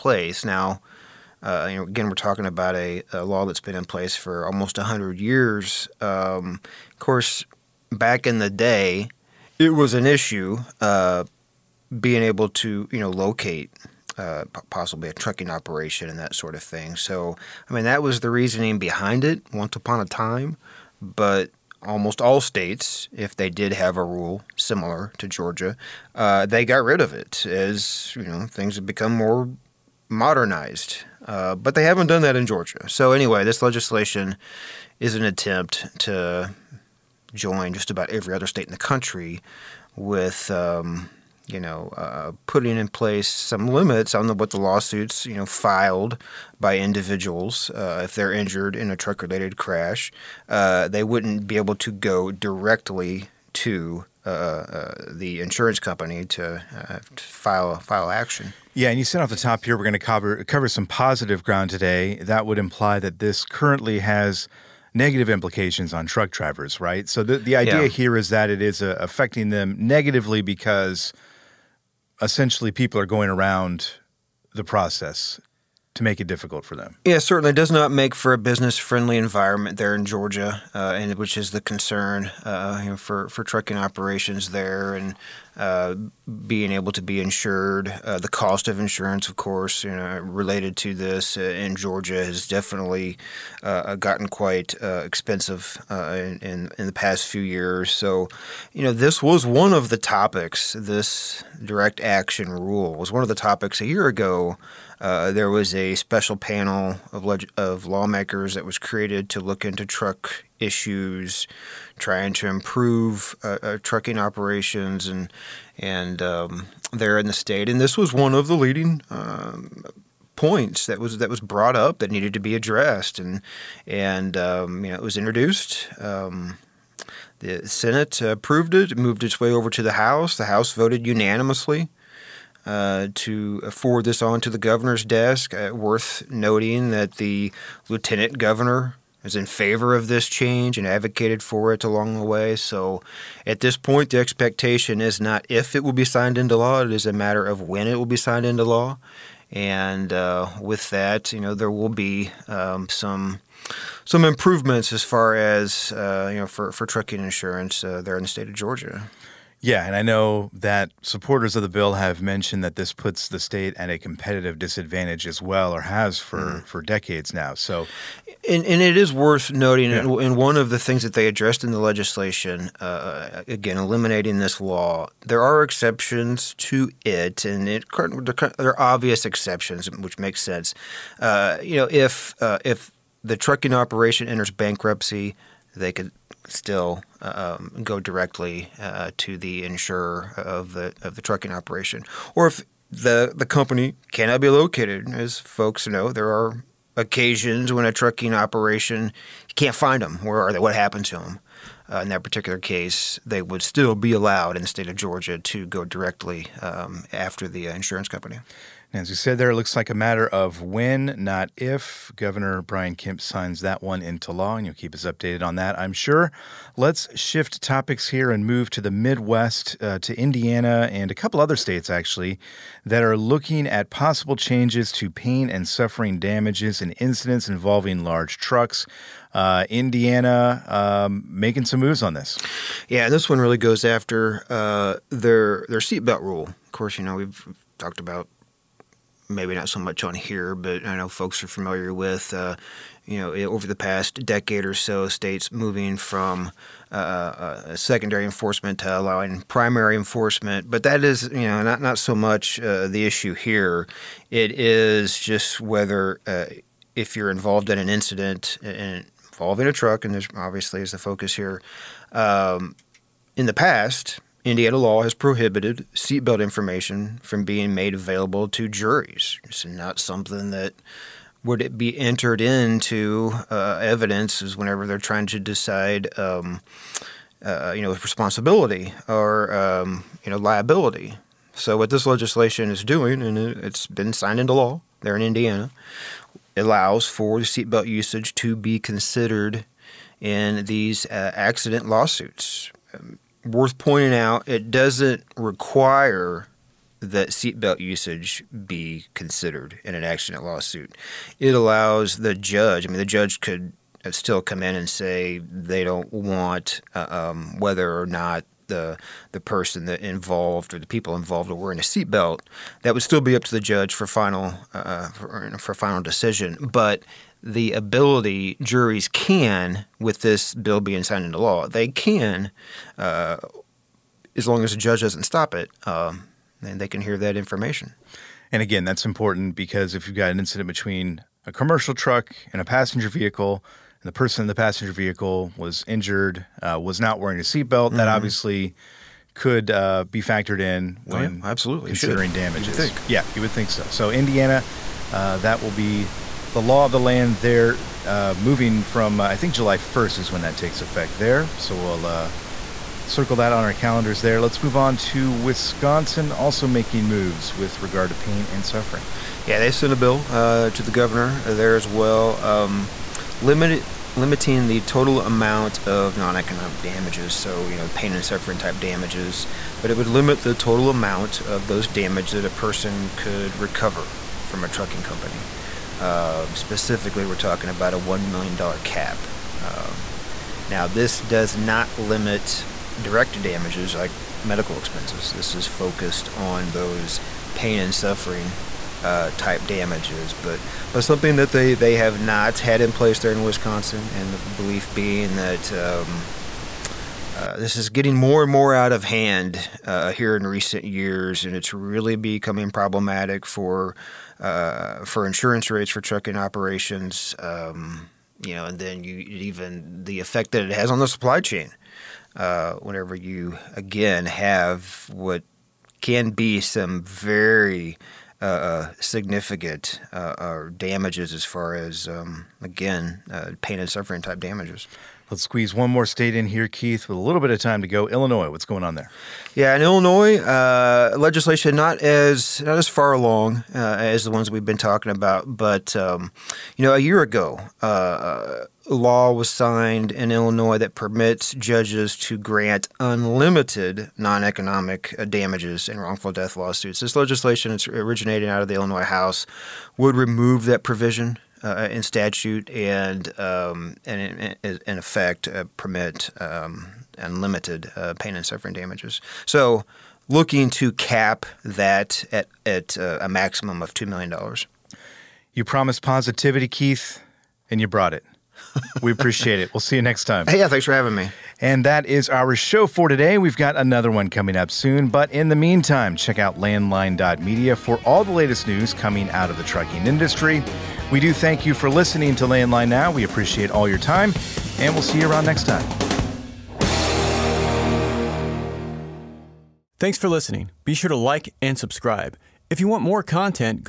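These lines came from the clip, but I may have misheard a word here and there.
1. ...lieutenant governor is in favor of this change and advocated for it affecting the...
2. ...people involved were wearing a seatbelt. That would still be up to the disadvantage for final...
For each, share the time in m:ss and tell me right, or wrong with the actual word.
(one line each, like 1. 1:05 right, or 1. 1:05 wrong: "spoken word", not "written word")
1. 2:17 wrong: "along", not "affecting"
2. 5:10 wrong: "judge", not "disadvantage".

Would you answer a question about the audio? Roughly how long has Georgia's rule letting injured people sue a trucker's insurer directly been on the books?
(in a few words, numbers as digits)
almost 100 years.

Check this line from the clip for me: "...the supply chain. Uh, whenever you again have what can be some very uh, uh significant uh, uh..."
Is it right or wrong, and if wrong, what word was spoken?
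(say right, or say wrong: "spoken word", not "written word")
right.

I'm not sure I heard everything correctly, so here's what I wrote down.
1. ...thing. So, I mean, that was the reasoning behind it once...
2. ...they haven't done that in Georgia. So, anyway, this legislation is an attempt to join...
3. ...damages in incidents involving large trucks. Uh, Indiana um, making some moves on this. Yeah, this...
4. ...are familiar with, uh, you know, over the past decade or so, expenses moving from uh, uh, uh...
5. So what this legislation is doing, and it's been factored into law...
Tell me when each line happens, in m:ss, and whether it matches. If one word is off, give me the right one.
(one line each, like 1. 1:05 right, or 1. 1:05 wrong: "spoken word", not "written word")
1. 0:16 right
2. 0:31 right
3. 3:46 right
4. 4:01 wrong: "states", not "expenses"
5. 4:41 wrong: "signed", not "factored".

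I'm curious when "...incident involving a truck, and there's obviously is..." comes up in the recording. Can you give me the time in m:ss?
4:17.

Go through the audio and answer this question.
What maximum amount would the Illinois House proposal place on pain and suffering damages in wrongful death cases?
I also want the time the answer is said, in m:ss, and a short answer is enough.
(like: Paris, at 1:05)
$2 million, at 7:43.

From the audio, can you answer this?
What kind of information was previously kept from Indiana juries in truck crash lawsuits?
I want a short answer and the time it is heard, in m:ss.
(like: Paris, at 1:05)
seatbelt information, at 4:25.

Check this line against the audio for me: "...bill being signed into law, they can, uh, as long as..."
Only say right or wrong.
right.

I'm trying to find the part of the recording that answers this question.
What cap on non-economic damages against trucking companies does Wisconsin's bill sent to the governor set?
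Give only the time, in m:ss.
6:17.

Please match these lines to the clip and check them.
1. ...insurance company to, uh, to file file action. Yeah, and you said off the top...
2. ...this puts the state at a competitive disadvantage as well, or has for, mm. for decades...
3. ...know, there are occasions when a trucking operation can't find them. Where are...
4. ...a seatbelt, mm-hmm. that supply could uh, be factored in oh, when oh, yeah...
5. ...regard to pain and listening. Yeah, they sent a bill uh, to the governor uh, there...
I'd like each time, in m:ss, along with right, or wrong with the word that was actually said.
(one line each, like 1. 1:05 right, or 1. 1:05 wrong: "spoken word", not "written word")
1. 0:55 right
2. 2:42 right
3. 3:15 right
4. 5:37 wrong: "obviously", not "supply"
5. 5:57 wrong: "suffering", not "listening".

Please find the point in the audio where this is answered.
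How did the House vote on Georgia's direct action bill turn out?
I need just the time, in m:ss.
2:11.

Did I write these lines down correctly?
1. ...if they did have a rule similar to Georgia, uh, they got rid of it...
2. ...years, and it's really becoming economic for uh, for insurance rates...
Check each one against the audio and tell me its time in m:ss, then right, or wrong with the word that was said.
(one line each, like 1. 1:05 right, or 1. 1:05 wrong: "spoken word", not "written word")
1. 0:23 right
2. 6:40 wrong: "problematic", not "economic".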